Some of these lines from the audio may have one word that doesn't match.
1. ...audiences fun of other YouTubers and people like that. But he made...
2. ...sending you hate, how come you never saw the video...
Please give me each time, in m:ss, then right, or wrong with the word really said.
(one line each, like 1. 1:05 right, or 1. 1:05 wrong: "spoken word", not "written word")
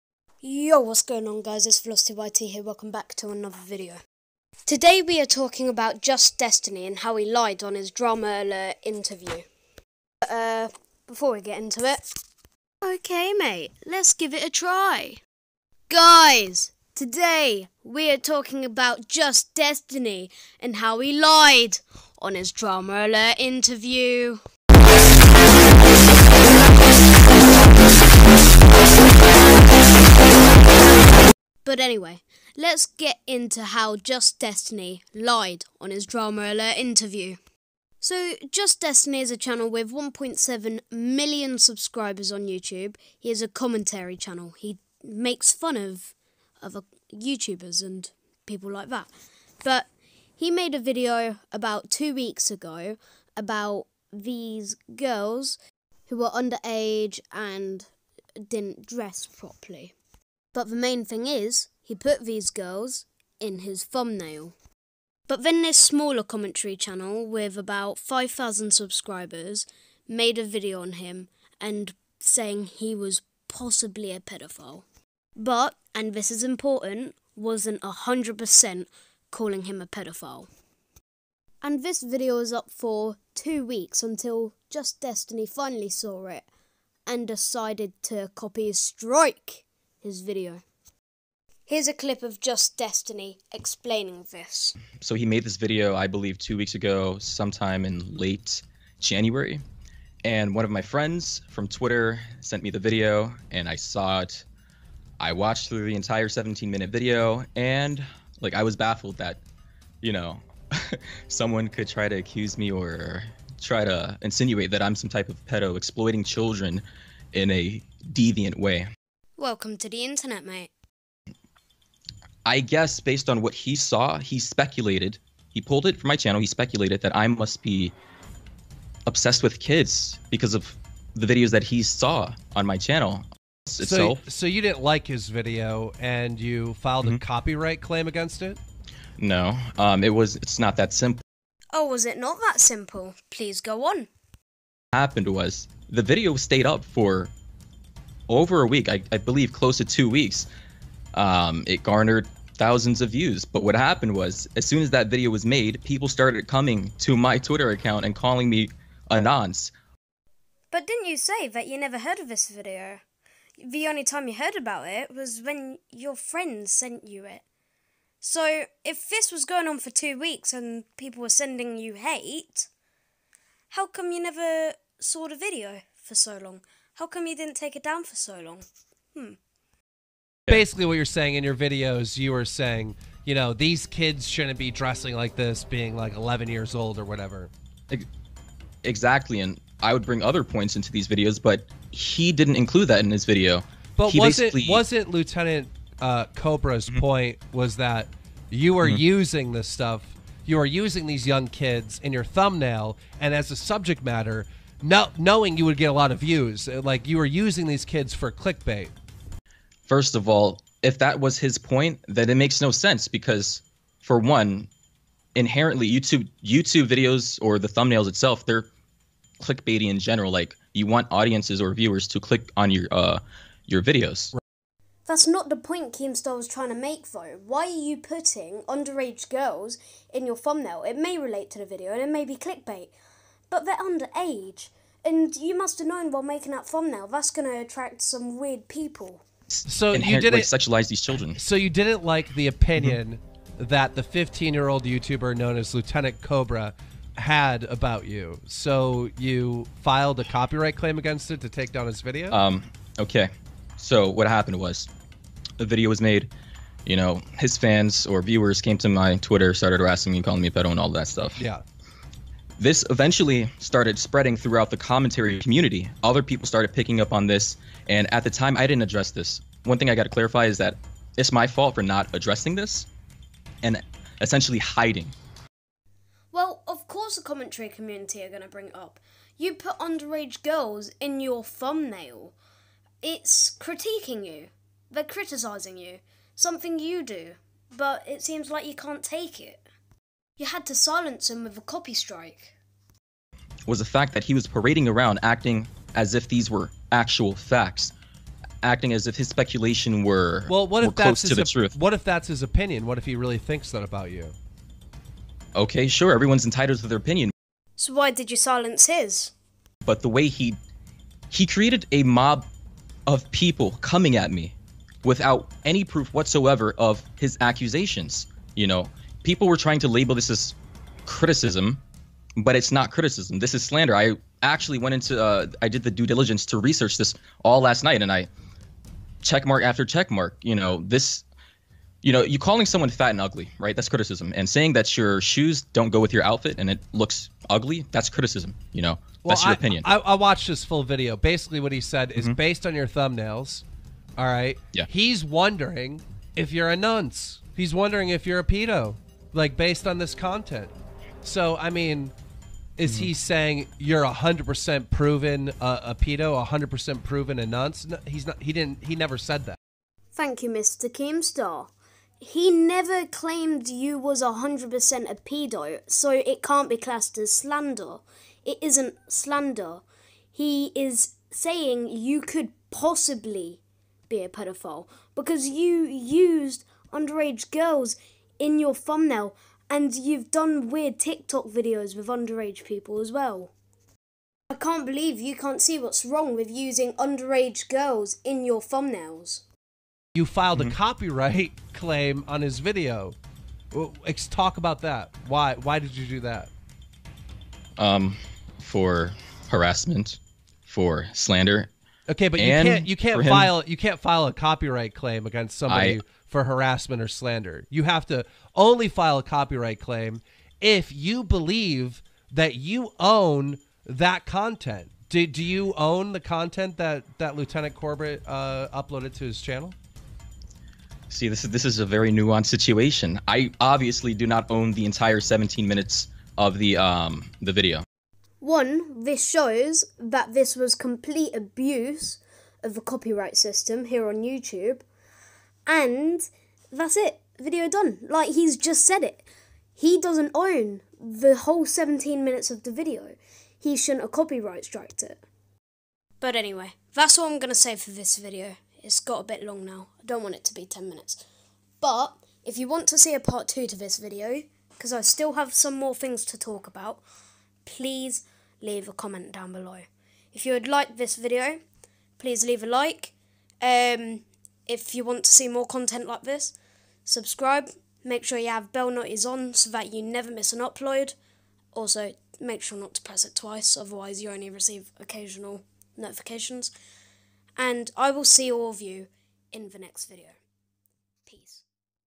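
1. 0:45 wrong: "makes", not "audiences"
2. 2:51 right.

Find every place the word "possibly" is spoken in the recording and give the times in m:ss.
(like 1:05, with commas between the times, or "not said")
1:13, 6:12.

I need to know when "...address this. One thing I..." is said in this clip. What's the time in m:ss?
4:28.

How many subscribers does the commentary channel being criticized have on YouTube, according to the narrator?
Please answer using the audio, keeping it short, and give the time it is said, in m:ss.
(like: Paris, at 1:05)
1.7 million, at 0:39.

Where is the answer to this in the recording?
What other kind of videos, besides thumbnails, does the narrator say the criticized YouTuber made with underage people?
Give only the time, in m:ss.
6:20.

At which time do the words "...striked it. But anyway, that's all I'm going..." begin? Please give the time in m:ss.
7:24.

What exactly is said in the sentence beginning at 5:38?
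You know, well, that's your I, opinion.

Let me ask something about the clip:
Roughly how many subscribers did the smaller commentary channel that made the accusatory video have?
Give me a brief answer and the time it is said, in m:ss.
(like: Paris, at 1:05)
5,000, at 1:07.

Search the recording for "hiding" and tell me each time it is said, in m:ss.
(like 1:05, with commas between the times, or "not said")
4:34.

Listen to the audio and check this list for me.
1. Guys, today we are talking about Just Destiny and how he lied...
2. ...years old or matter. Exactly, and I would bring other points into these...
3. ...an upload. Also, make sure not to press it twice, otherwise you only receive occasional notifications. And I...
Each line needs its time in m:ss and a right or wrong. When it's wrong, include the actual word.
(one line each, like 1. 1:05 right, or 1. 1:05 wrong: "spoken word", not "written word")
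1. 0:15 right
2. 3:06 wrong: "whatever", not "matter"
3. 7:50 right.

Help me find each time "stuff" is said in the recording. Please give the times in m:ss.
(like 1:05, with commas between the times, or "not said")
3:19, 4:21.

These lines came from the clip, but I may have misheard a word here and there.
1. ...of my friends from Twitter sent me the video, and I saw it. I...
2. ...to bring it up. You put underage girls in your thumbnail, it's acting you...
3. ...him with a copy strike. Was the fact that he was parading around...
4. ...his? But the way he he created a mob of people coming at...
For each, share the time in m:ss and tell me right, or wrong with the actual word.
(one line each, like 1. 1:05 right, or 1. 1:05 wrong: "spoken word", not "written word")
1. 1:40 right
2. 4:38 wrong: "critiquing", not "acting"
3. 4:51 right
4. 5:08 right.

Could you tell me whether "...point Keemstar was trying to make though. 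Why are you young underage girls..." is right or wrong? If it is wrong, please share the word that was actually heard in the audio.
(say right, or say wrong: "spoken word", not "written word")
wrong: "putting", not "young".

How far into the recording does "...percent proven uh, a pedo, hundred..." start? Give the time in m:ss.
5:54.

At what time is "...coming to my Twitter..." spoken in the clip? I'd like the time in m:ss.
2:36.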